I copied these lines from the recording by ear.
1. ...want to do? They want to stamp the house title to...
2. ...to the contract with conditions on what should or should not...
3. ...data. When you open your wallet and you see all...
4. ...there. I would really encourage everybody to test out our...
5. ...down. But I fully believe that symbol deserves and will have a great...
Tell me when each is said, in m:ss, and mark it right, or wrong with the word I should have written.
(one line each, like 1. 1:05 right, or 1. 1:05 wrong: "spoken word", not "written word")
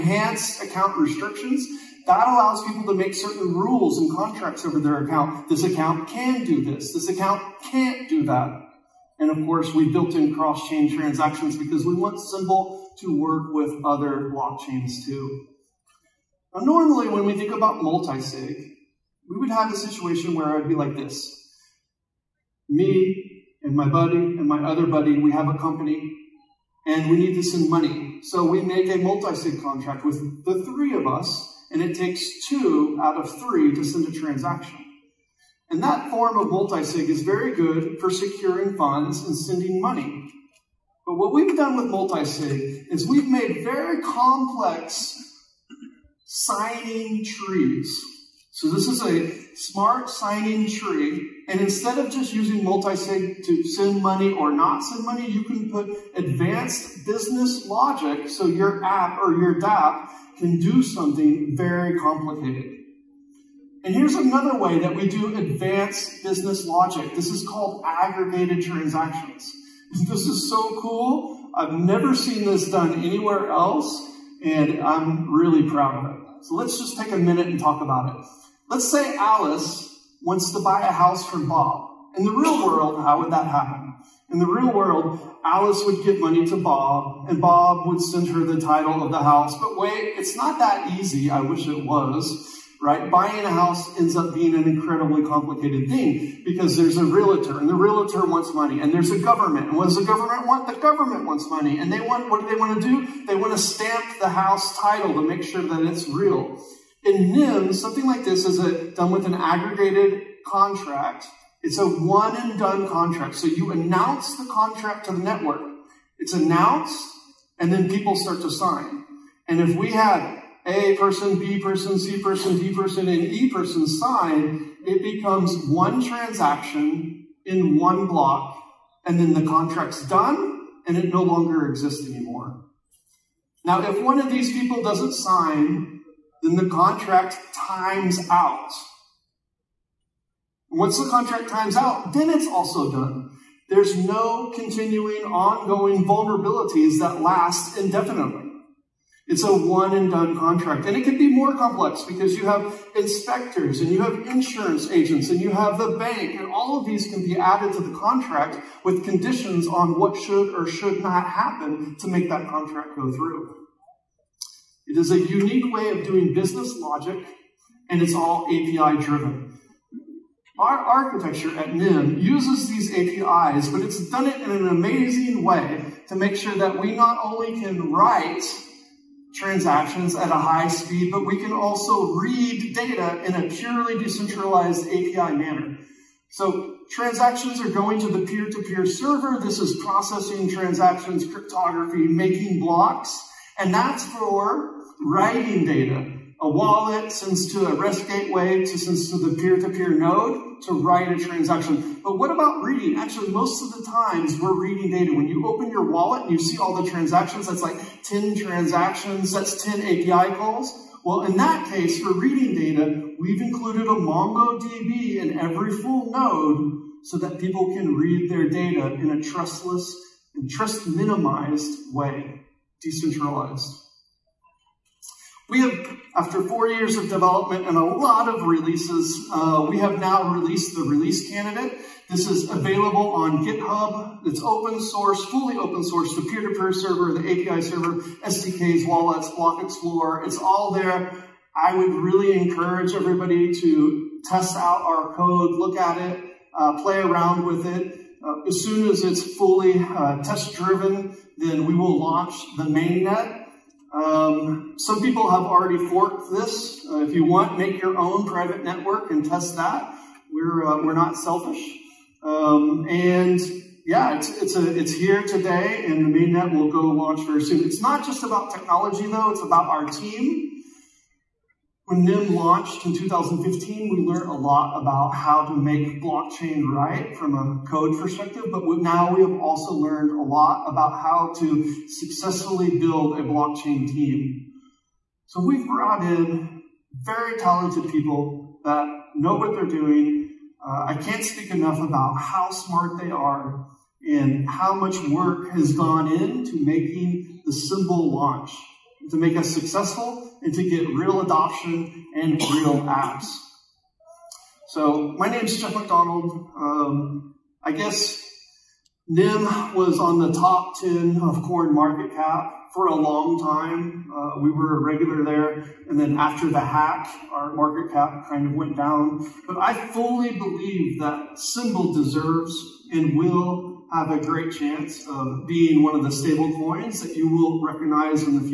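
1. 1:42 right
2. 2:37 right
3. 3:24 right
4. 4:00 right
5. 5:18 right.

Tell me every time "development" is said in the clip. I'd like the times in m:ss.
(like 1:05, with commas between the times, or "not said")
3:47.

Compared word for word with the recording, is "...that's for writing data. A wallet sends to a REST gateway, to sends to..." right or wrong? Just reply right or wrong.
right.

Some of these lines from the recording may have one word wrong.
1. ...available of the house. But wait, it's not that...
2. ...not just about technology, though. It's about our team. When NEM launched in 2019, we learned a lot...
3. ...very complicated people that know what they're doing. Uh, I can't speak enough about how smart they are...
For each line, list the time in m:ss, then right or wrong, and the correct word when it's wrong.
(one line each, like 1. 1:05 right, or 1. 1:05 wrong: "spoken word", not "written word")
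1. 1:28 wrong: "title", not "available"
2. 4:27 wrong: "2015", not "2019"
3. 4:47 wrong: "talented", not "complicated".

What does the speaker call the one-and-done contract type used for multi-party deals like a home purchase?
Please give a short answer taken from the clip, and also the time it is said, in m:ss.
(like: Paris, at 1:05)
aggregated transactions, at 1:07.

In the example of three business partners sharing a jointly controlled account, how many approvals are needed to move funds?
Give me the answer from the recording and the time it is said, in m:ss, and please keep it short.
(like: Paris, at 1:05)
2 out of 3, at 0:32.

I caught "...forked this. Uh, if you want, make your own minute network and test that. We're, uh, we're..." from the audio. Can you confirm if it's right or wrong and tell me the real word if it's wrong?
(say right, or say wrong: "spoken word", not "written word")
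wrong: "private", not "minute".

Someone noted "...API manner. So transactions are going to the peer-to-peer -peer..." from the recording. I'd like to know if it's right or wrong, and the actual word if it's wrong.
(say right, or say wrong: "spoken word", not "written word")
right.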